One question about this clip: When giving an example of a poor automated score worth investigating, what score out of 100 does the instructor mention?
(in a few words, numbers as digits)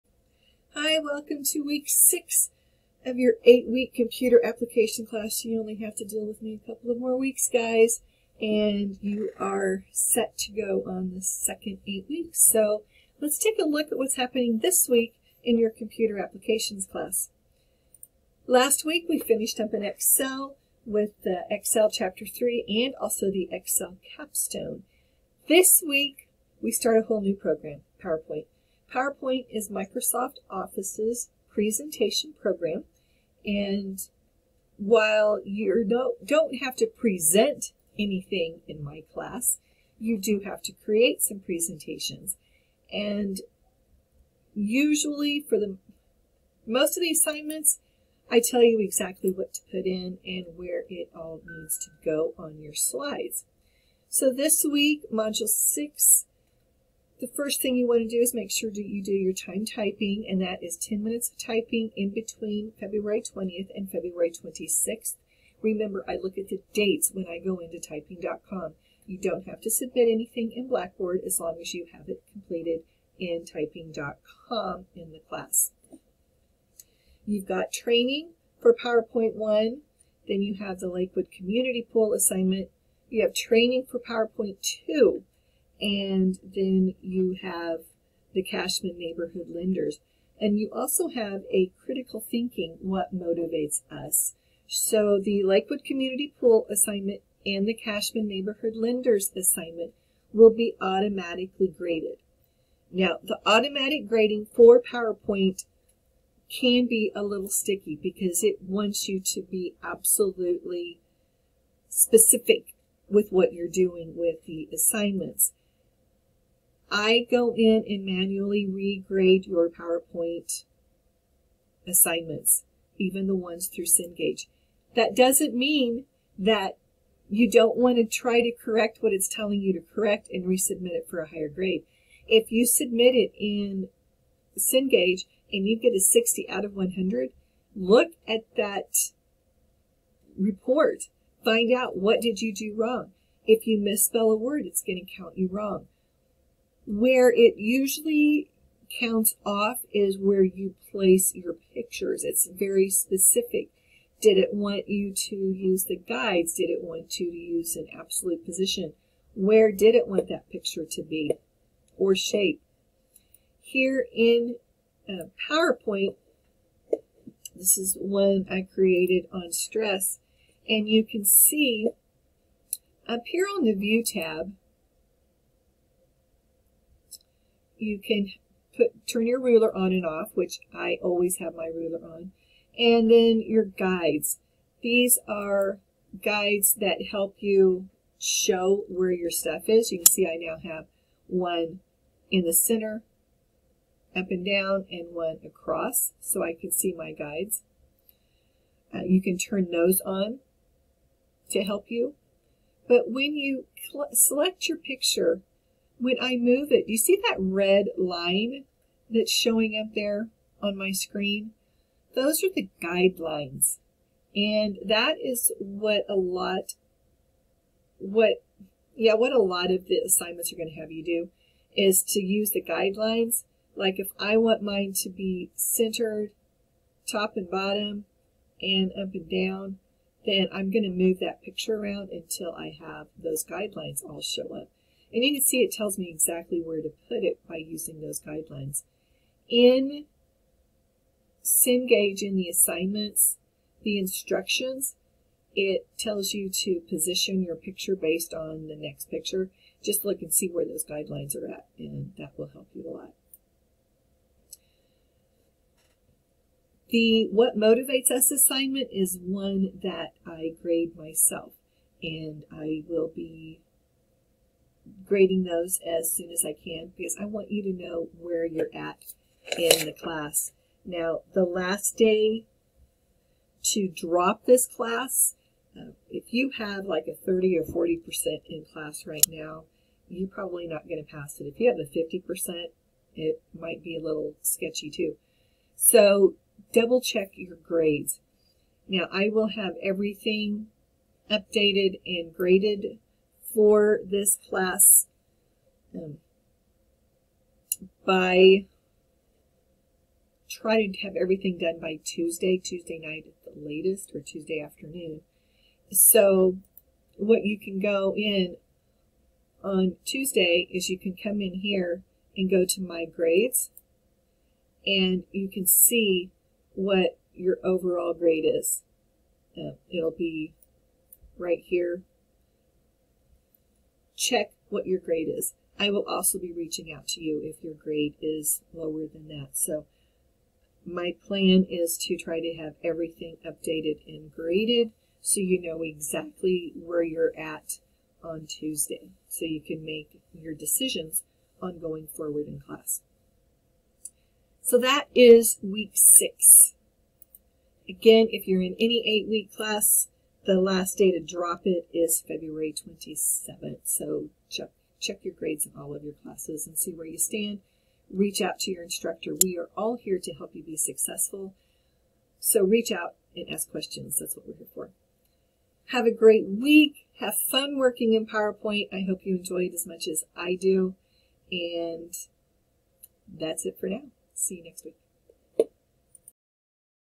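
60.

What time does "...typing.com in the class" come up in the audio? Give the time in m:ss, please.
1:13.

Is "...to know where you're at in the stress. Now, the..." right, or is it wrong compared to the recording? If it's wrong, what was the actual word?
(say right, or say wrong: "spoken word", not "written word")
wrong: "class", not "stress".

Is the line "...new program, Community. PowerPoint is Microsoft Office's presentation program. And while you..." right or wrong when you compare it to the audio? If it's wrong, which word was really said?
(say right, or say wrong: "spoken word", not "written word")
wrong: "PowerPoint", not "Community".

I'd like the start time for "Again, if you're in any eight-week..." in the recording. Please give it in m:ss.
5:47.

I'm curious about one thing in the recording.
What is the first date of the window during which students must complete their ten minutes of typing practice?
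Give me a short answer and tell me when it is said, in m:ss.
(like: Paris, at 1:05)
February 20th, at 1:02.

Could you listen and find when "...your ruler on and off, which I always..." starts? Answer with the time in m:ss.
2:59.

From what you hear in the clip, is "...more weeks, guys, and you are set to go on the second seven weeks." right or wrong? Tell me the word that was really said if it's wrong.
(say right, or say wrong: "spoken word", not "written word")
wrong: "eight", not "seven".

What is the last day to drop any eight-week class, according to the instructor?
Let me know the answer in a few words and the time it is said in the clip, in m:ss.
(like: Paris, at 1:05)
February 27th, at 5:52.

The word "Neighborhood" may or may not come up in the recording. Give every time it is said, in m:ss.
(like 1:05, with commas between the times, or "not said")
1:28, 1:38.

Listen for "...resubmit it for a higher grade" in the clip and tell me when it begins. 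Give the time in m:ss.
2:10.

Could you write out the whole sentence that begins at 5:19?
Uh, it'll be right here check what your grade is.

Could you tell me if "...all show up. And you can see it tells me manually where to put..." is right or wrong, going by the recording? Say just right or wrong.
wrong.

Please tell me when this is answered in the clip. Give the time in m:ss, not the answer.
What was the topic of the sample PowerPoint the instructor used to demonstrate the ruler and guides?
2:49.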